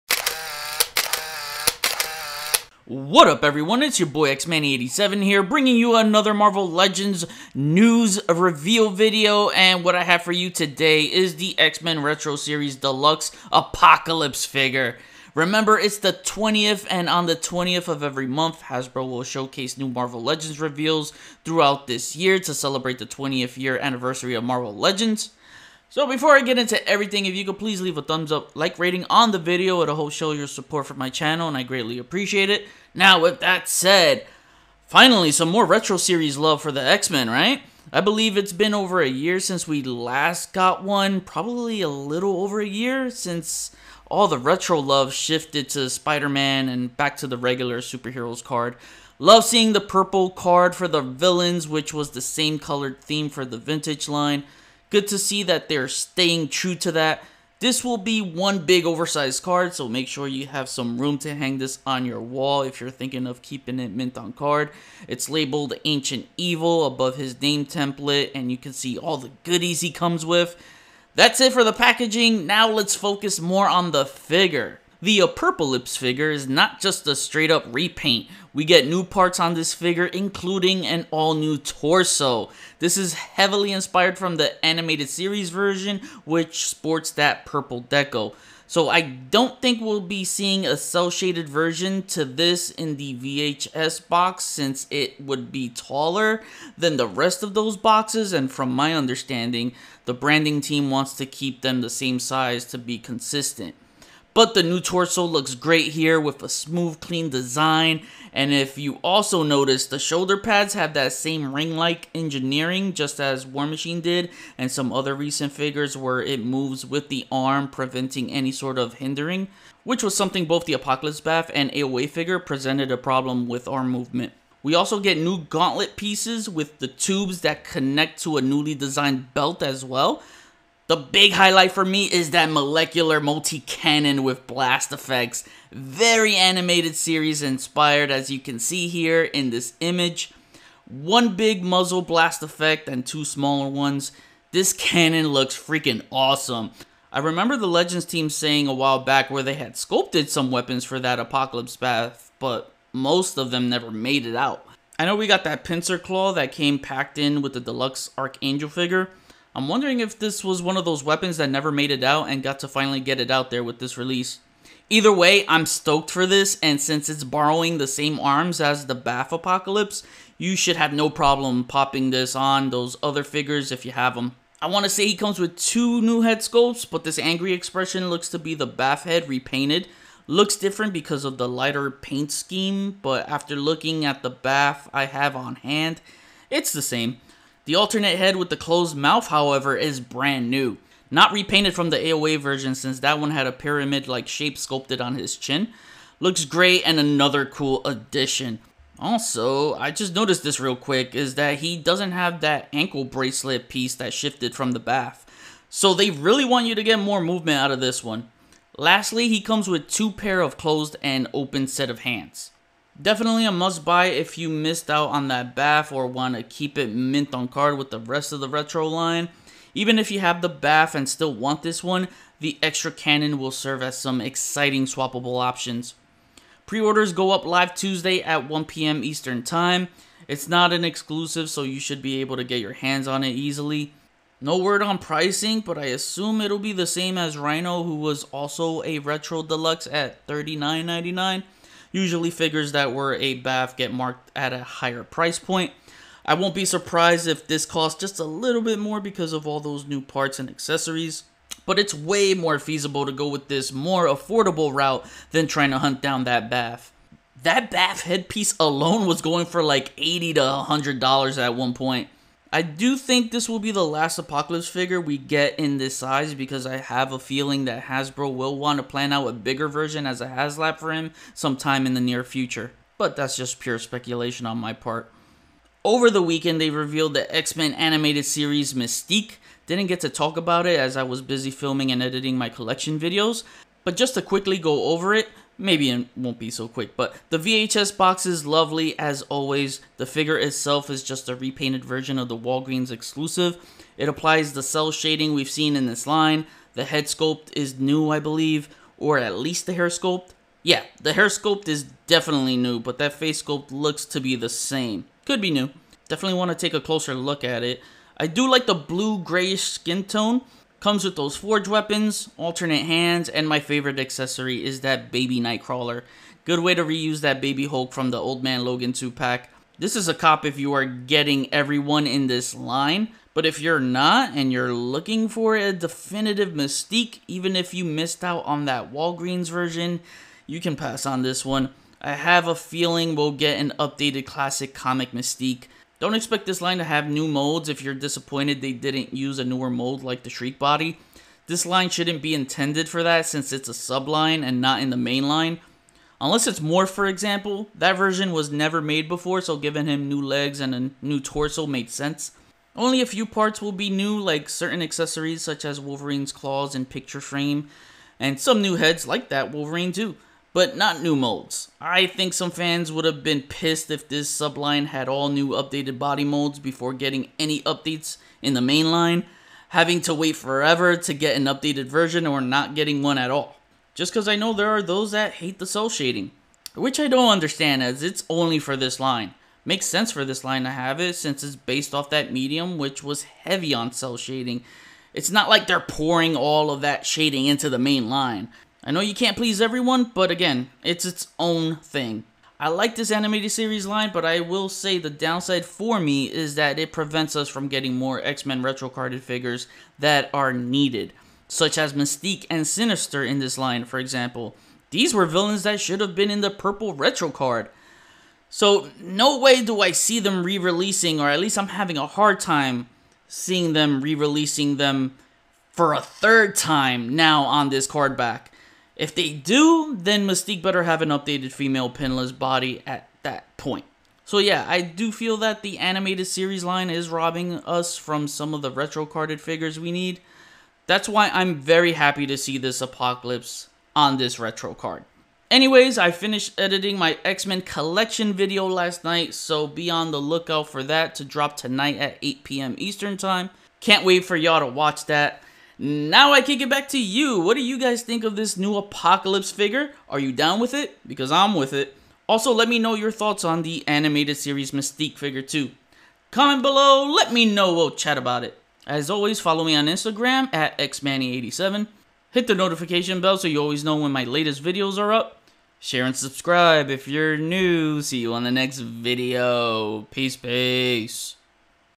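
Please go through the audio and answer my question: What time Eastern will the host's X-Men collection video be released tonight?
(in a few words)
8 p.m.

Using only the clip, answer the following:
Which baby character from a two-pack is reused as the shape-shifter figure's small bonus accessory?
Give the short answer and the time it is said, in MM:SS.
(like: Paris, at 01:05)
baby Hulk, at 05:17.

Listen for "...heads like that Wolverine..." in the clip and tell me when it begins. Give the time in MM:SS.
05:58.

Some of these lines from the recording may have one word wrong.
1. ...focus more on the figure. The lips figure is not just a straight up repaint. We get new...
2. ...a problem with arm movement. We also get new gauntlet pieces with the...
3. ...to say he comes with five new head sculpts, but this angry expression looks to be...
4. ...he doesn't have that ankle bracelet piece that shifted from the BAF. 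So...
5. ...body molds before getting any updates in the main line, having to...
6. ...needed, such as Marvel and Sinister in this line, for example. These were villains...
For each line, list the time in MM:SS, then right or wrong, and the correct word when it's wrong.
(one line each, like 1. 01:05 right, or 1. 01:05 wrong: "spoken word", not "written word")
1. 01:12 right
2. 02:02 right
3. 02:54 wrong: "two", not "five"
4. 03:21 right
5. 06:05 right
6. 06:40 wrong: "Mystique", not "Marvel".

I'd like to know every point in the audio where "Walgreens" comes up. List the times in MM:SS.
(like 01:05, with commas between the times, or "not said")
04:52, 05:28.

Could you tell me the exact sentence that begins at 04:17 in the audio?
That BAF headpiece alone was going for like 80 to $100 at one point.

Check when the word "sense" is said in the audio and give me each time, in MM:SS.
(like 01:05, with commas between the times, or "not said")
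05:51, 06:19.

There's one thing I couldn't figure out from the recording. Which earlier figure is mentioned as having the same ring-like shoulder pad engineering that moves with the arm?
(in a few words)
War Machine.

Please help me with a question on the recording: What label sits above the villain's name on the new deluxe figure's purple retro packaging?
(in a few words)
Ancient Evil.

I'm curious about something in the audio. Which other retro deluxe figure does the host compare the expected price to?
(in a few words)
Rhino.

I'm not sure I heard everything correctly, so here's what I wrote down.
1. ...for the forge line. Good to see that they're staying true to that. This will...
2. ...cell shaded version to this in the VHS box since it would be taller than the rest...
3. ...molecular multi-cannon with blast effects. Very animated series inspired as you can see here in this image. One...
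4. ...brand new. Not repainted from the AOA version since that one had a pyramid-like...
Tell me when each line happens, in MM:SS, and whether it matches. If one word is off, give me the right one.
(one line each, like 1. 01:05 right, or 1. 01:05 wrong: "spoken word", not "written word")
1. 00:53 wrong: "vintage", not "forge"
2. 01:30 right
3. 02:12 right
4. 03:10 right.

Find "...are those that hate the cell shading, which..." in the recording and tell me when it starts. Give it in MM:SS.
06:14.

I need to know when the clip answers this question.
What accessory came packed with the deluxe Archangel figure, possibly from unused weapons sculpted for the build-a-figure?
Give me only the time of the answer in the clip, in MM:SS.
02:35.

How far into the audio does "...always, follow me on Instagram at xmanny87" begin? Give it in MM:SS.
07:39.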